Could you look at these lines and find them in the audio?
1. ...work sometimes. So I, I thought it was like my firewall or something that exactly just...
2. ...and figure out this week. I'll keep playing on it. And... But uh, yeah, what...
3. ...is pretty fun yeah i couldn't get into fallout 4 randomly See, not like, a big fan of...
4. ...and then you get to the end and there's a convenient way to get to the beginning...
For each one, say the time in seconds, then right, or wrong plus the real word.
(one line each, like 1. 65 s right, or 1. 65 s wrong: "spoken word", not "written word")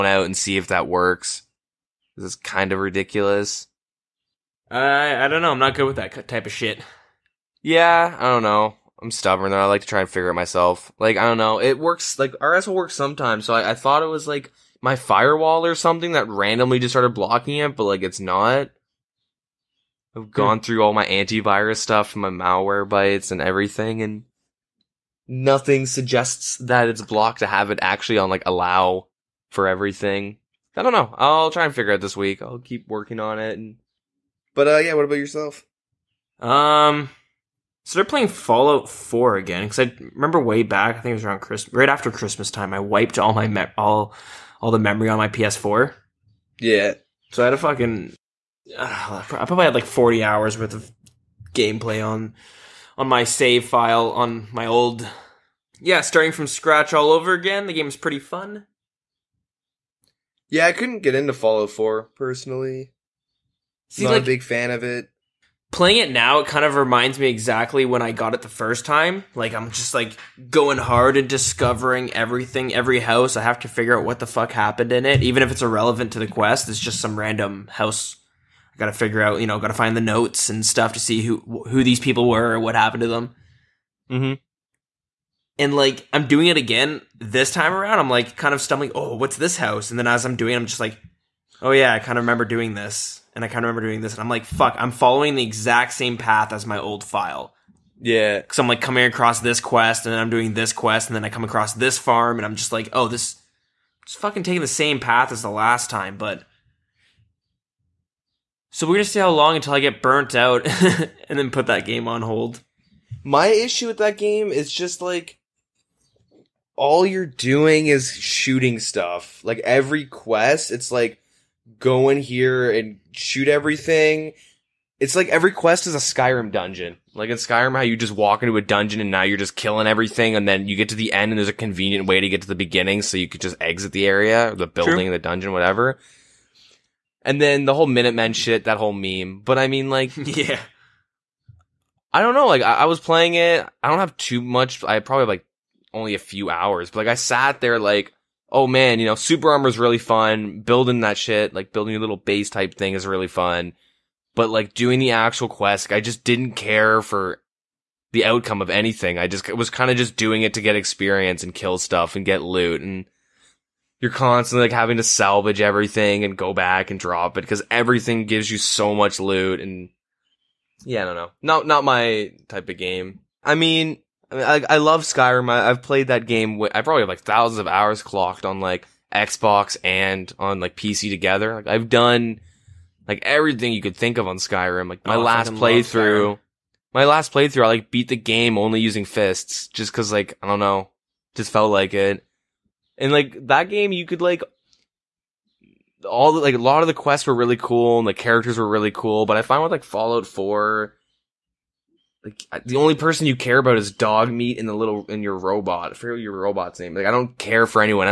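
1. 12 s wrong: "randomly", not "exactly"
2. 31 s wrong: "working", not "playing"
3. 57 s wrong: "personally", not "randomly"
4. 130 s right.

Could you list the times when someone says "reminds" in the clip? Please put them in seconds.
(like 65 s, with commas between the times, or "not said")
66 s.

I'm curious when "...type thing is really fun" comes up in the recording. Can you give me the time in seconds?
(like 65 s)
152 s.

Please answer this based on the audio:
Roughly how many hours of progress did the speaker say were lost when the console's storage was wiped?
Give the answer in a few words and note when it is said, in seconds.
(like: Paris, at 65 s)
40, at 49 s.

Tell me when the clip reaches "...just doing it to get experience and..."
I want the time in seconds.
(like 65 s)
159 s.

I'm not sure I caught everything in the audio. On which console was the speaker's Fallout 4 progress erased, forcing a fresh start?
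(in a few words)
PS4.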